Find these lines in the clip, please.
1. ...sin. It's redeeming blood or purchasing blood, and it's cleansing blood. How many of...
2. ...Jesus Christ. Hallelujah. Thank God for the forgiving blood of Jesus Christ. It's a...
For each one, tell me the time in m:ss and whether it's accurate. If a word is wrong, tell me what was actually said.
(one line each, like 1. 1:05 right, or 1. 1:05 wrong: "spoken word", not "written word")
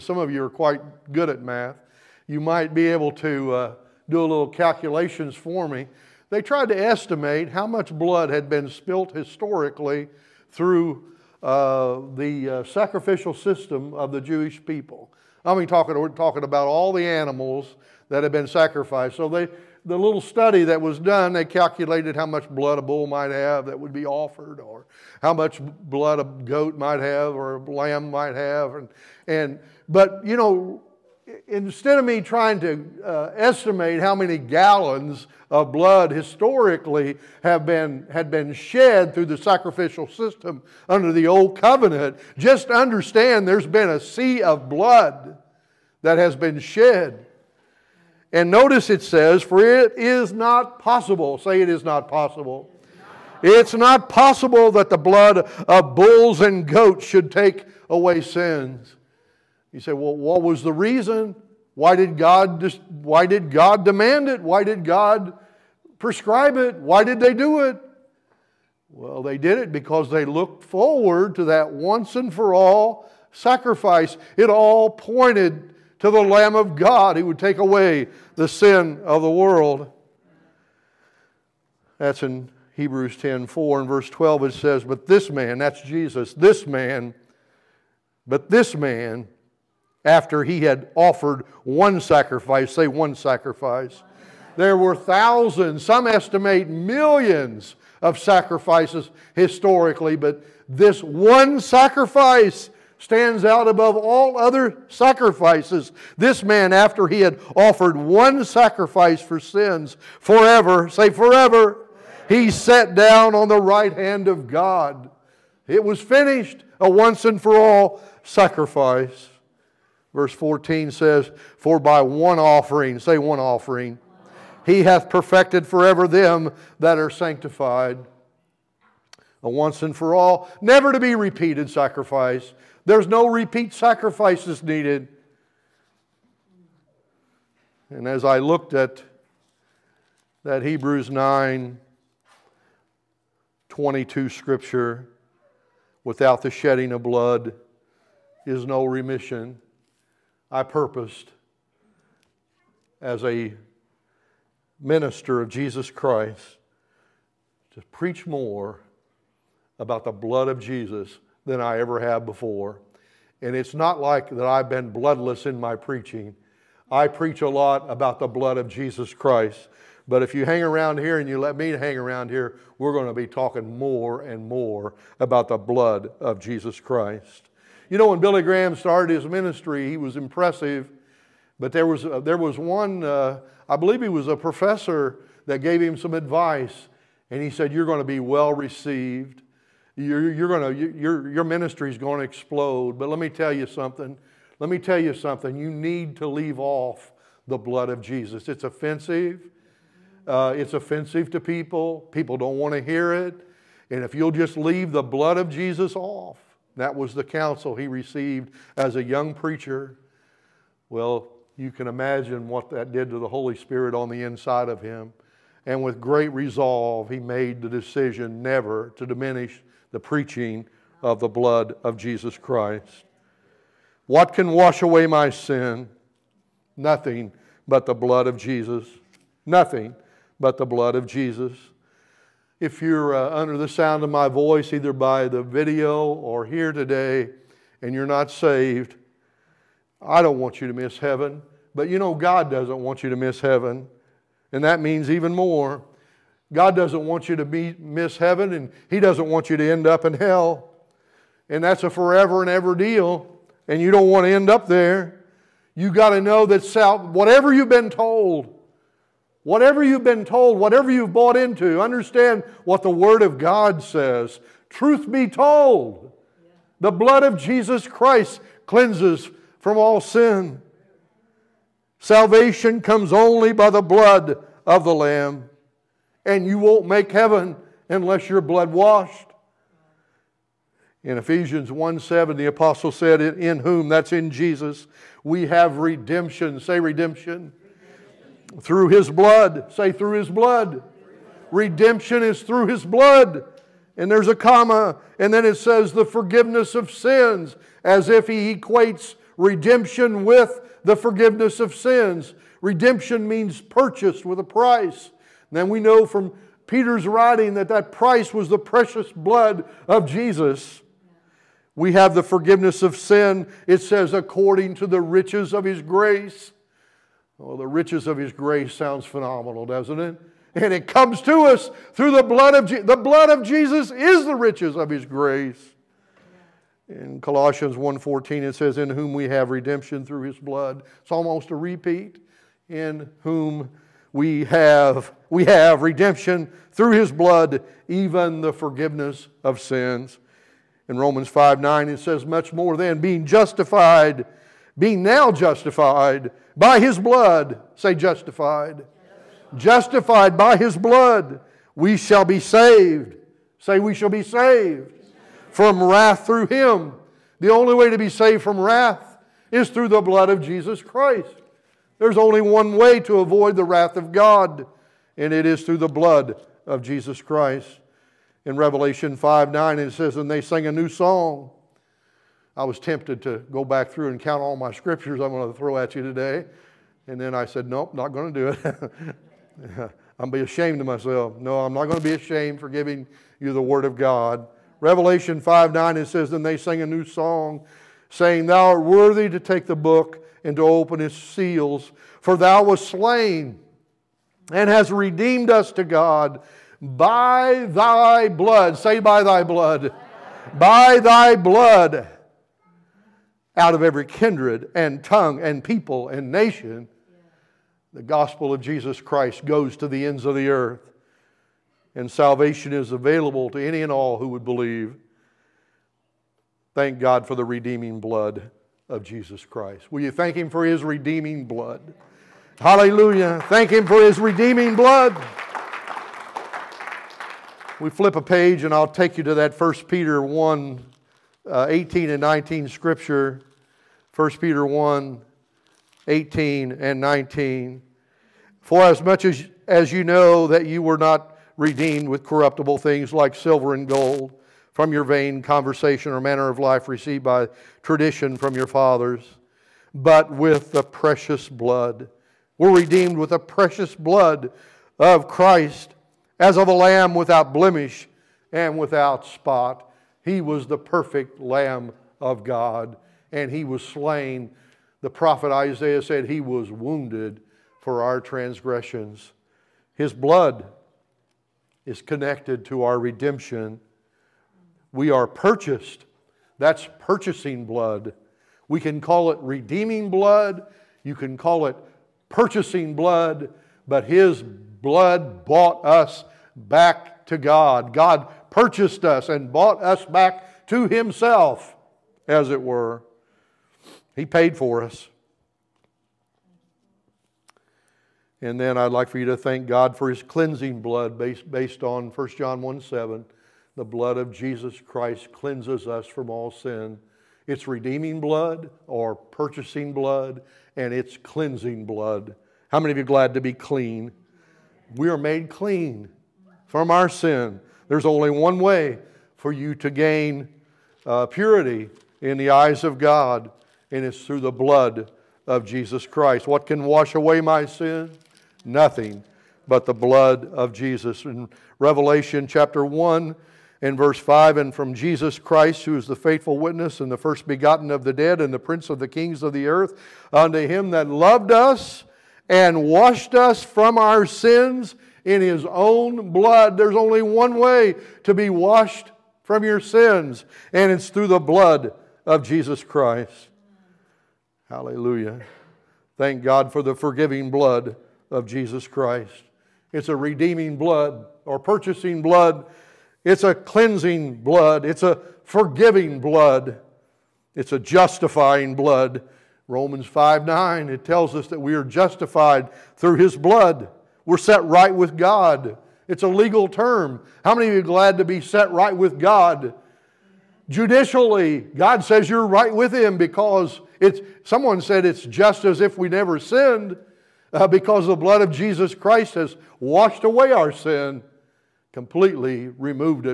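1. 8:26 right
2. 9:12 right.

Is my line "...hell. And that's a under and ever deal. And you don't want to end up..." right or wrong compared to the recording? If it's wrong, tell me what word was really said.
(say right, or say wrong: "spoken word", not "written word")
wrong: "forever", not "under".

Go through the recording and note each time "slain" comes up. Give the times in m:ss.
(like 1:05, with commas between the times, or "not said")
6:32, 7:43.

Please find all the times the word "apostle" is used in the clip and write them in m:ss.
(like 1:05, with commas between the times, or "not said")
4:42.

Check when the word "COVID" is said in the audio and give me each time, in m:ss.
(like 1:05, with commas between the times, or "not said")
not said.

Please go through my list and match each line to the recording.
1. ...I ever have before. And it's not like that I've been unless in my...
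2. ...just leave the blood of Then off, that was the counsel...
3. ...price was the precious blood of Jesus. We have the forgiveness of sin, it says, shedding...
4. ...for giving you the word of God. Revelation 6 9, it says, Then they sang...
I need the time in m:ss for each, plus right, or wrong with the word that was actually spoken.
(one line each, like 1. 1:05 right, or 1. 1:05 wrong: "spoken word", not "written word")
1. 2:41 wrong: "bloodless", not "unless"
2. 3:24 wrong: "Jesus", not "Then"
3. 5:07 wrong: "according", not "shedding"
4. 6:22 wrong: "5", not "6".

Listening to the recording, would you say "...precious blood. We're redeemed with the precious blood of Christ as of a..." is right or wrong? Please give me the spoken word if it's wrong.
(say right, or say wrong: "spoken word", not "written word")
right.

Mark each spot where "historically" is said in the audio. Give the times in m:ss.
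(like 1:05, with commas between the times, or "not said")
0:09, 0:36, 1:39.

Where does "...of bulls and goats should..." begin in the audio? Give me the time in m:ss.
0:55.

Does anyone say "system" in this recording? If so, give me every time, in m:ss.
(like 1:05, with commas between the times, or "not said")
0:13, 0:40.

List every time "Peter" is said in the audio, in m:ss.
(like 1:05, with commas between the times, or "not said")
5:06, 7:09, 7:14.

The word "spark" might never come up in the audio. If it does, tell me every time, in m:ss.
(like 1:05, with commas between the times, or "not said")
not said.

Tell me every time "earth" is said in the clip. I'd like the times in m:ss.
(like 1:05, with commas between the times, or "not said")
6:50, 8:59.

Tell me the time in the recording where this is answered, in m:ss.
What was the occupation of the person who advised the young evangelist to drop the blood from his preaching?
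3:04.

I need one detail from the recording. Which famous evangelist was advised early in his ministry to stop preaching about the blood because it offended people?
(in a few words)
Billy Graham.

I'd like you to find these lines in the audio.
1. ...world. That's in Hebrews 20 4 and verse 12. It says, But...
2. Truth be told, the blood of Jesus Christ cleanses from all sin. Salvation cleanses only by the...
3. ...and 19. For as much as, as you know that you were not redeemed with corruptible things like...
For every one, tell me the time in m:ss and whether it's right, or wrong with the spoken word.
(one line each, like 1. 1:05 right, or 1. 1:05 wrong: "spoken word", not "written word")
1. 1:19 wrong: "10", not "20"
2. 4:24 wrong: "comes", not "cleanses"
3. 7:16 right.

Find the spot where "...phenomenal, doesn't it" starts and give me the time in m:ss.
5:19.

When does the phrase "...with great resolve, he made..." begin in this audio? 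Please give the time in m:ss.
3:35.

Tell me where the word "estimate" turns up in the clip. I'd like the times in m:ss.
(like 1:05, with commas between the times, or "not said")
0:06, 0:33, 1:36.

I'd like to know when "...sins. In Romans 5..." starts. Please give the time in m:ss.
5:39.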